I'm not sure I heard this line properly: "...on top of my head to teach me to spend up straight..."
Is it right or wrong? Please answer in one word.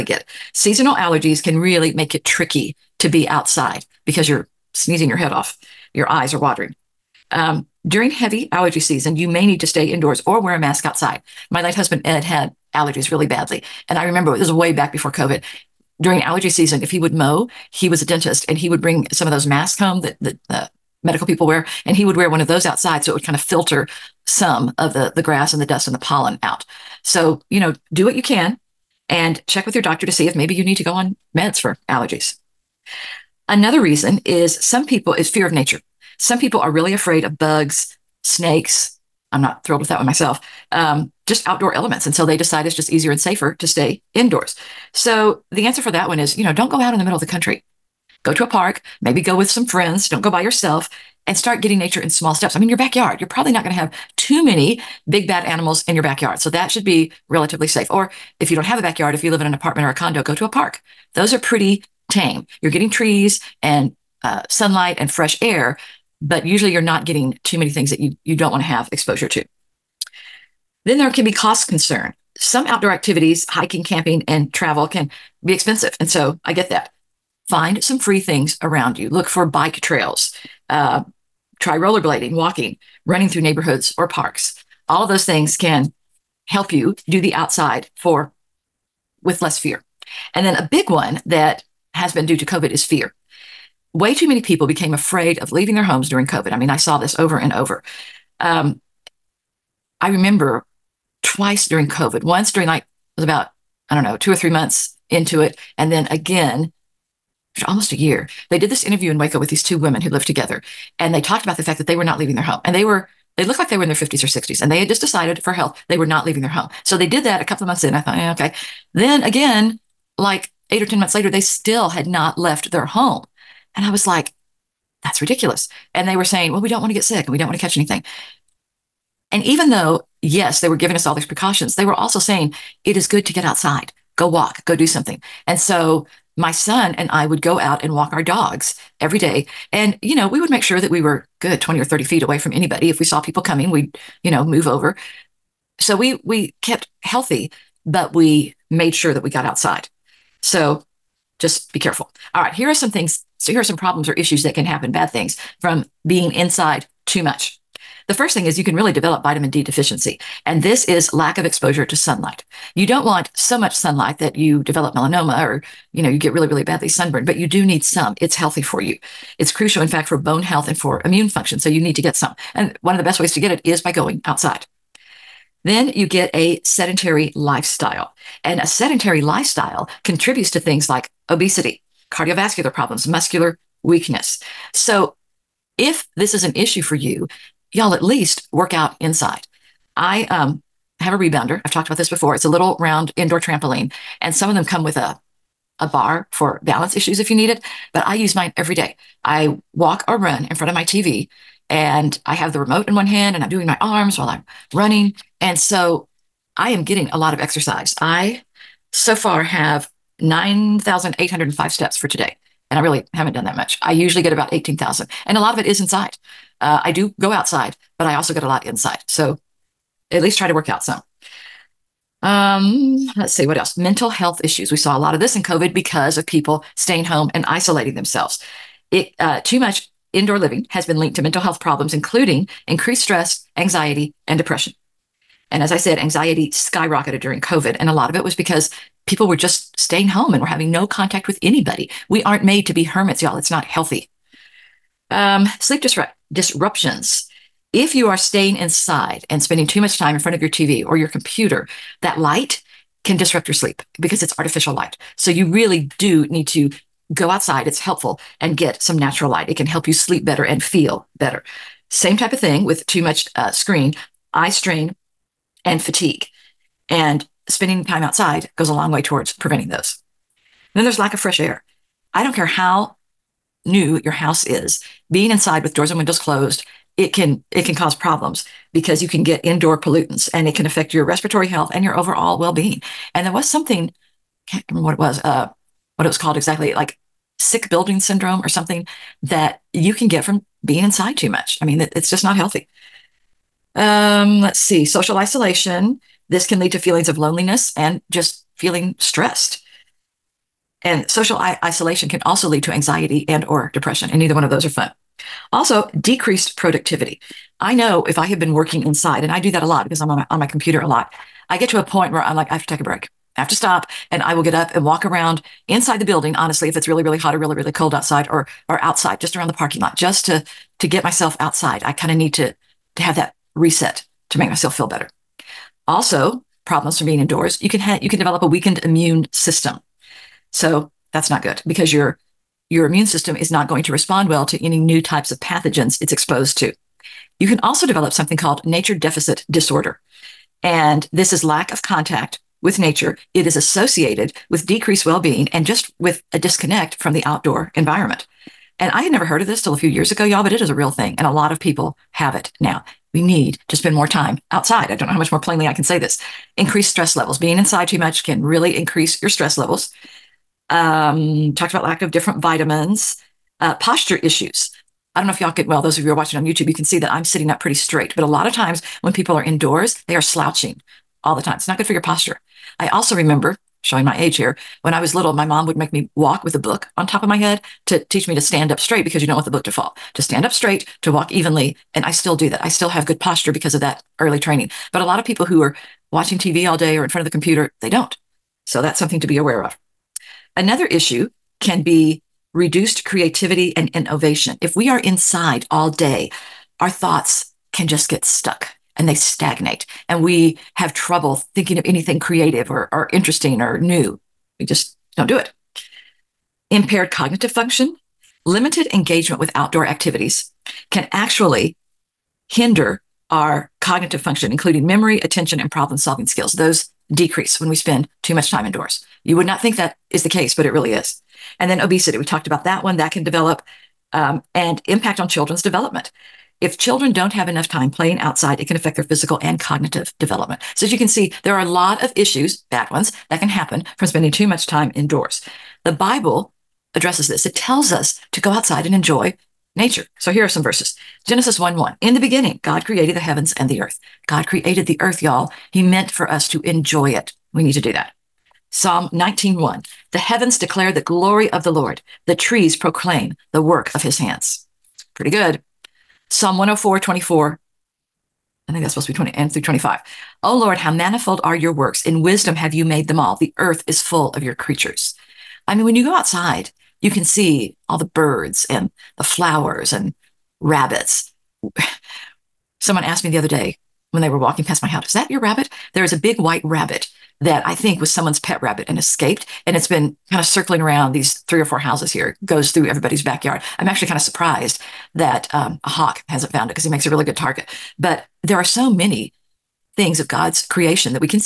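wrong.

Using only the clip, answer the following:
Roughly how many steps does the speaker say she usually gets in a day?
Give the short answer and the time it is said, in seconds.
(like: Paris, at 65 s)
18,000, at 214 s.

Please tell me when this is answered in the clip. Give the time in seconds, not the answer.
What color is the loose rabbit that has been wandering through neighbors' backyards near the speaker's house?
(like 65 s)
476 s.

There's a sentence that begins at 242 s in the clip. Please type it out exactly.
We aren't made to be hermits, y'all.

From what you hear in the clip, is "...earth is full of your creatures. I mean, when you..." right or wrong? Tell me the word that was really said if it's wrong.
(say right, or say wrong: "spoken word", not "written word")
right.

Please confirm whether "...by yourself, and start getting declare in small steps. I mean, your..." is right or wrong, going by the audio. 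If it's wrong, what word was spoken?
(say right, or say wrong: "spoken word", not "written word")
wrong: "nature", not "declare".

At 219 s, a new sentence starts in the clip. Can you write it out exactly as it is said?
So at least try to work out some.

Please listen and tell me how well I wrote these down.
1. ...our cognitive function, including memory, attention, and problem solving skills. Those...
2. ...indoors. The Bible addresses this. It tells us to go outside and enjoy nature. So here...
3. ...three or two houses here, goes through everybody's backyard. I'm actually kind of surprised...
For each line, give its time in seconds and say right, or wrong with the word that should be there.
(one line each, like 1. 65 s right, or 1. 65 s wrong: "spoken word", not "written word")
1. 413 s right
2. 434 s right
3. 481 s wrong: "four", not "two".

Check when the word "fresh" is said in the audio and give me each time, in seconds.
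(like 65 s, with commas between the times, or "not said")
65 s, 271 s.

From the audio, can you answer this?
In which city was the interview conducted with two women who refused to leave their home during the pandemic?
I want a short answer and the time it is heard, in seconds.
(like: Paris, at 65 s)
Waco, at 109 s.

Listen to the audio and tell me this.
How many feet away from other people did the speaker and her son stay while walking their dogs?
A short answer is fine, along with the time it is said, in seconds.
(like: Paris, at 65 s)
20 or 30 feet, at 141 s.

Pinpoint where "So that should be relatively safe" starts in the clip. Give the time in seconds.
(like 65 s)
56 s.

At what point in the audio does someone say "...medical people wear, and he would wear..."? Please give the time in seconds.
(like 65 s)
21 s.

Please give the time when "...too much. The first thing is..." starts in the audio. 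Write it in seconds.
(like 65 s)
157 s.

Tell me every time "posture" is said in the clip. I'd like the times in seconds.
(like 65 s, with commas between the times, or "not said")
363 s, 371 s, 383 s.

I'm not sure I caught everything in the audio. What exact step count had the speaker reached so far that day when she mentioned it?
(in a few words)
9,805.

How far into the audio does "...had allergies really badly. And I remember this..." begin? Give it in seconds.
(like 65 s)
12 s.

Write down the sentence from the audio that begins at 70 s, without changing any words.
Then there can be cost concern.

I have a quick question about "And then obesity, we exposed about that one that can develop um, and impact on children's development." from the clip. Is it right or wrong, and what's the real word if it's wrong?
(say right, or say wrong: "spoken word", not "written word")
wrong: "talked", not "exposed".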